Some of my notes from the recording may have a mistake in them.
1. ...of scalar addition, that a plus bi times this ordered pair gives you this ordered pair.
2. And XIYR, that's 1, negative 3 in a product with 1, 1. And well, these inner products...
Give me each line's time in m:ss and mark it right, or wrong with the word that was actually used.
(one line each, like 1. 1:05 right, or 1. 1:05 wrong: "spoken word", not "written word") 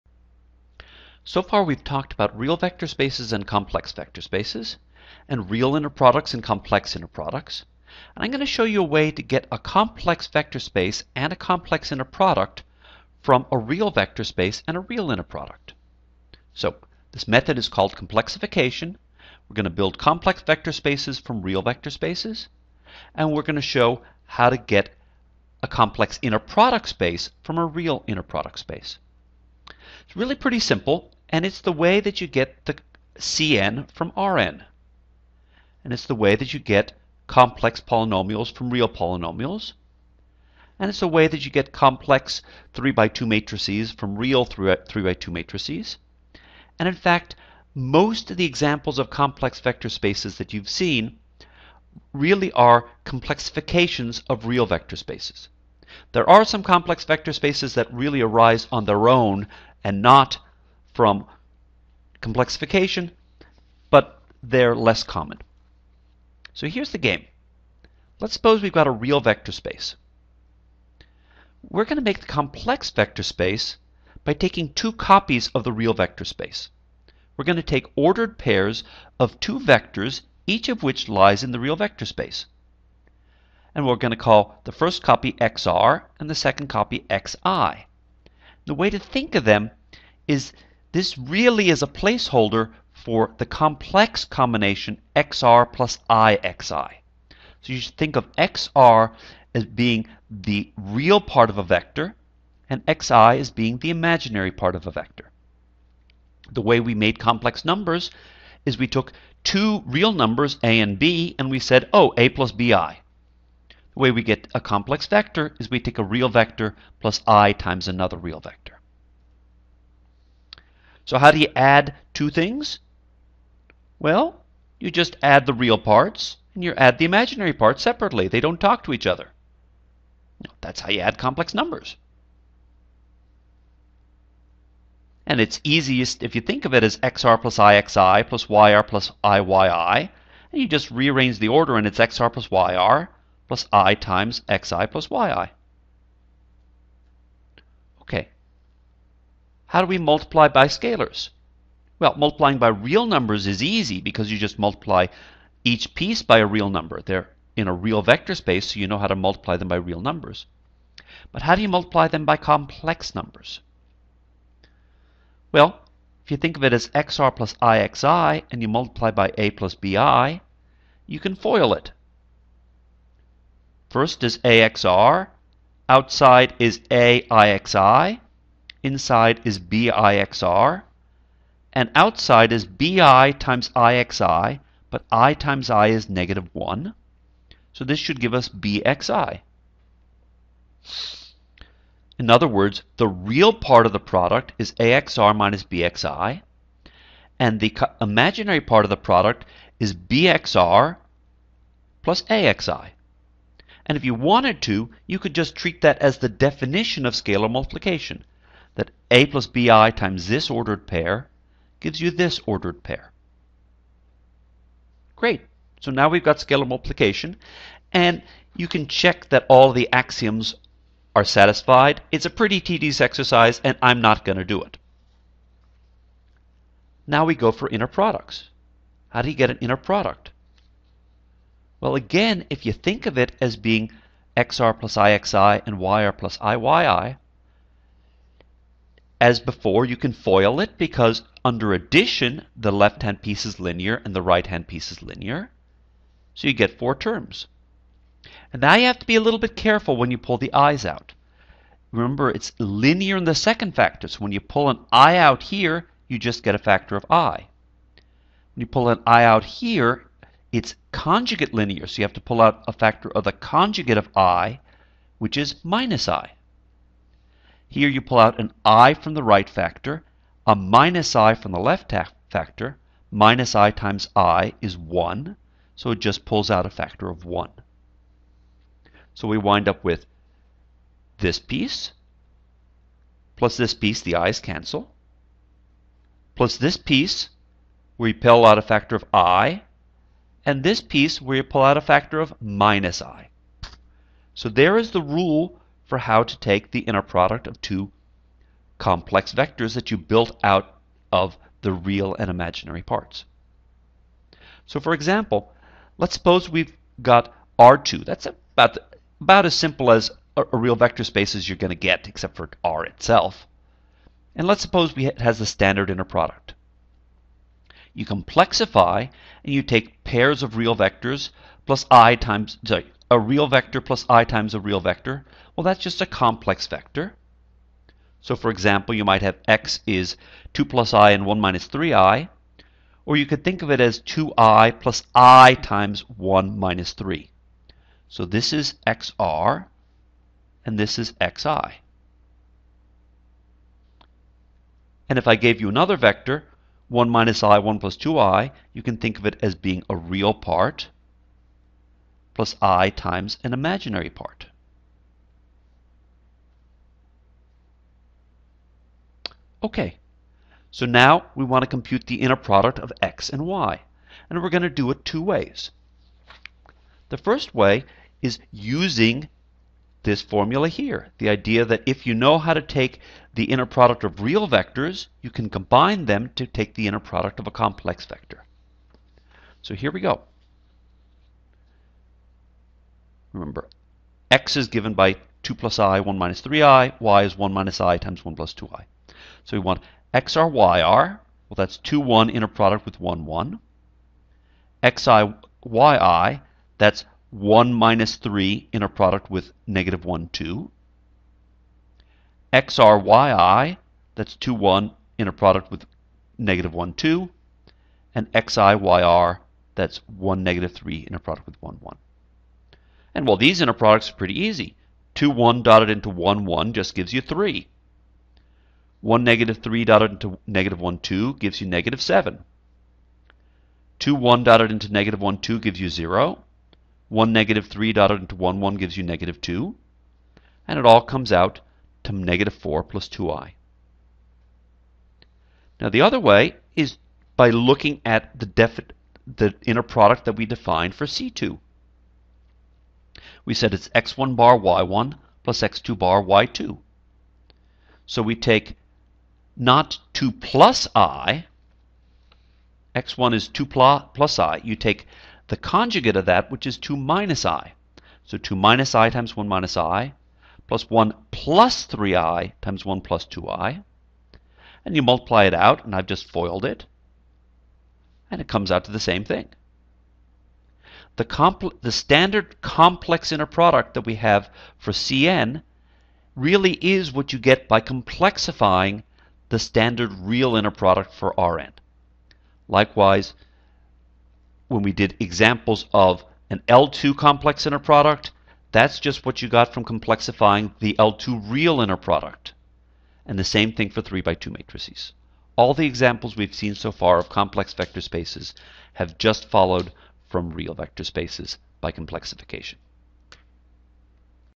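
1. 3:27 wrong: "multiplication", not "addition"
2. 6:48 right.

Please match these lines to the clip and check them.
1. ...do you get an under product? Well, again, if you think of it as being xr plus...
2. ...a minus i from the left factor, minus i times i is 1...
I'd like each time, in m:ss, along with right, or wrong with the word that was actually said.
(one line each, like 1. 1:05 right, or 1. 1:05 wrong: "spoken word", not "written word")
1. 3:49 wrong: "inner", not "under"
2. 4:30 right.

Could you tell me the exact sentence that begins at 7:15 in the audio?
Now the other way is by looking at the, the inner product that we defined for C2.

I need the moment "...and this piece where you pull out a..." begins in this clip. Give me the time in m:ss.
4:50.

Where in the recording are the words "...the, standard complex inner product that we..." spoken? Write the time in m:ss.
7:51.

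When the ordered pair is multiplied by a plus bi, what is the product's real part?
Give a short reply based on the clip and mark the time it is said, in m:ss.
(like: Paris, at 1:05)
AXR minus BXI, at 3:14.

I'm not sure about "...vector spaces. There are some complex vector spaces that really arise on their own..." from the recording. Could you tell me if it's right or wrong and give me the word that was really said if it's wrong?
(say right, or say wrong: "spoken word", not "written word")
right.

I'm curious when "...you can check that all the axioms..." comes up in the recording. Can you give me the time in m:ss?
3:38.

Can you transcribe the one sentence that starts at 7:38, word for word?
So 2 minus i times 1 minus i, plus 1 plus 3i times 1 plus 2i.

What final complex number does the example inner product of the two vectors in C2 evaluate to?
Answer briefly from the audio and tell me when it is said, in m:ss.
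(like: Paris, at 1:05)
-4 + 2i, at 7:12.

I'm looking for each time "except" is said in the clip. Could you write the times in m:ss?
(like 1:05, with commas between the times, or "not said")
5:12.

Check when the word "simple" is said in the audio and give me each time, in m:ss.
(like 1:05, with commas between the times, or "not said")
0:30, 5:09.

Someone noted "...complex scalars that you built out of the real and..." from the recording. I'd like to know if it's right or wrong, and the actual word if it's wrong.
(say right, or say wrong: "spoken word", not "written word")
wrong: "vectors", not "scalars".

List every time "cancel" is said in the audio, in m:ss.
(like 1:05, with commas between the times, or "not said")
4:44.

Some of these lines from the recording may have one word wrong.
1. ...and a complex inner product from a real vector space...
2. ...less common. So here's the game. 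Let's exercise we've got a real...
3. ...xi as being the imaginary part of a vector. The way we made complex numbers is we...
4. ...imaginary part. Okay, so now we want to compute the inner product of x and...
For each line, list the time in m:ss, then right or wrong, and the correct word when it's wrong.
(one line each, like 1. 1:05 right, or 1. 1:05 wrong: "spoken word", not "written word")
1. 0:11 right
2. 1:04 wrong: "suppose", not "exercise"
3. 1:43 right
4. 5:53 right.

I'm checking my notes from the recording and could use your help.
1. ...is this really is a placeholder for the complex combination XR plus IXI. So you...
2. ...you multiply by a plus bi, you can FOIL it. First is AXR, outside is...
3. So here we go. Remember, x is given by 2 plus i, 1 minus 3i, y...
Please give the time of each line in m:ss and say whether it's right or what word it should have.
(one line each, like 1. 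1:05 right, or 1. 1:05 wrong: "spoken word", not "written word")
1. 1:30 right
2. 2:48 right
3. 6:19 right.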